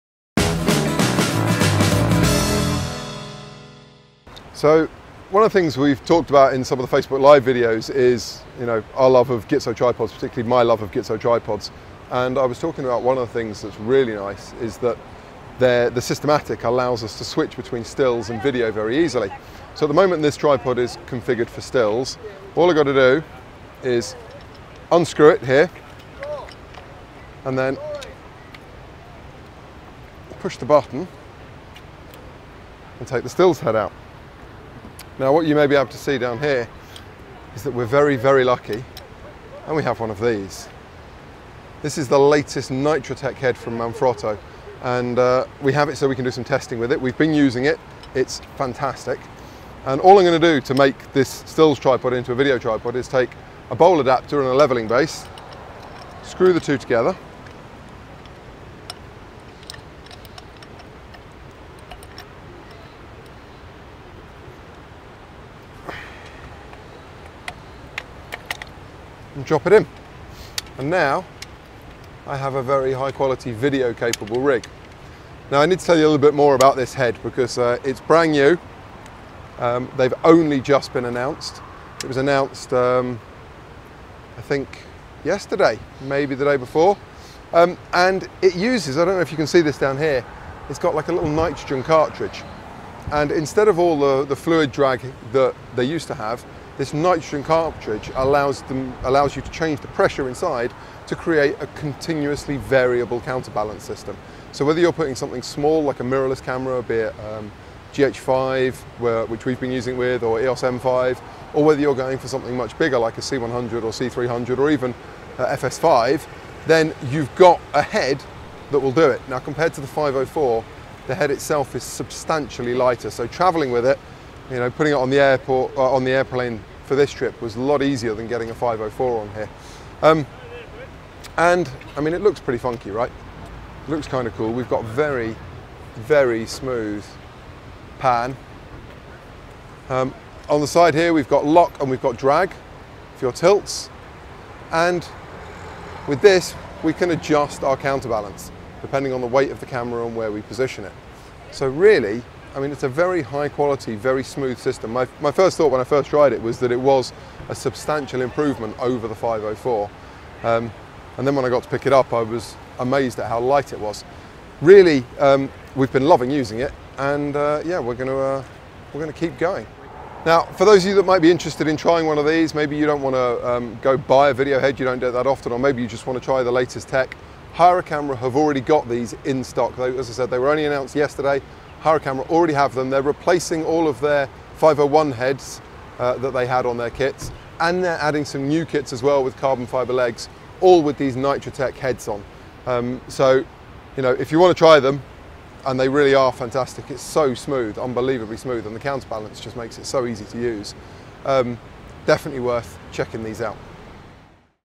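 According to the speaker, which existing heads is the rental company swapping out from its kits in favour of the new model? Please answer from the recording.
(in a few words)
501 heads.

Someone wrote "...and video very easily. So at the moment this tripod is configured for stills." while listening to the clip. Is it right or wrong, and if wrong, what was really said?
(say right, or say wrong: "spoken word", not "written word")
right.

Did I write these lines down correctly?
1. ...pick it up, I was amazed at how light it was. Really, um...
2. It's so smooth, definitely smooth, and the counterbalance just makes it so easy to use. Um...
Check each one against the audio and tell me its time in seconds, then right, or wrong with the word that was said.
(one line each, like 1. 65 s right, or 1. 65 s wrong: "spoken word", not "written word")
1. 161 s right
2. 196 s wrong: "unbelievably", not "definitely".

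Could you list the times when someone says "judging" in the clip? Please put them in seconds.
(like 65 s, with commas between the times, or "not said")
not said.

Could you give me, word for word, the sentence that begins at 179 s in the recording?
They, as I said, they were only announced yesterday.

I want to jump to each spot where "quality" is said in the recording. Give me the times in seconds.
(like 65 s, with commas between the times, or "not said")
73 s, 153 s.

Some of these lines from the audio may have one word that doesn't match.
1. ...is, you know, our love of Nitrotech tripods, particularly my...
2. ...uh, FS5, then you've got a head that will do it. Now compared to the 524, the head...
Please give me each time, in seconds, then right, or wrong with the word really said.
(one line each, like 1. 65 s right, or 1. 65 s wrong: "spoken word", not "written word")
1. 7 s wrong: "Gitzo", not "Nitrotech"
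2. 115 s wrong: "504", not "524".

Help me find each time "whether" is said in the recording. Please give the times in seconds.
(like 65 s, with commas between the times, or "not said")
104 s, 111 s.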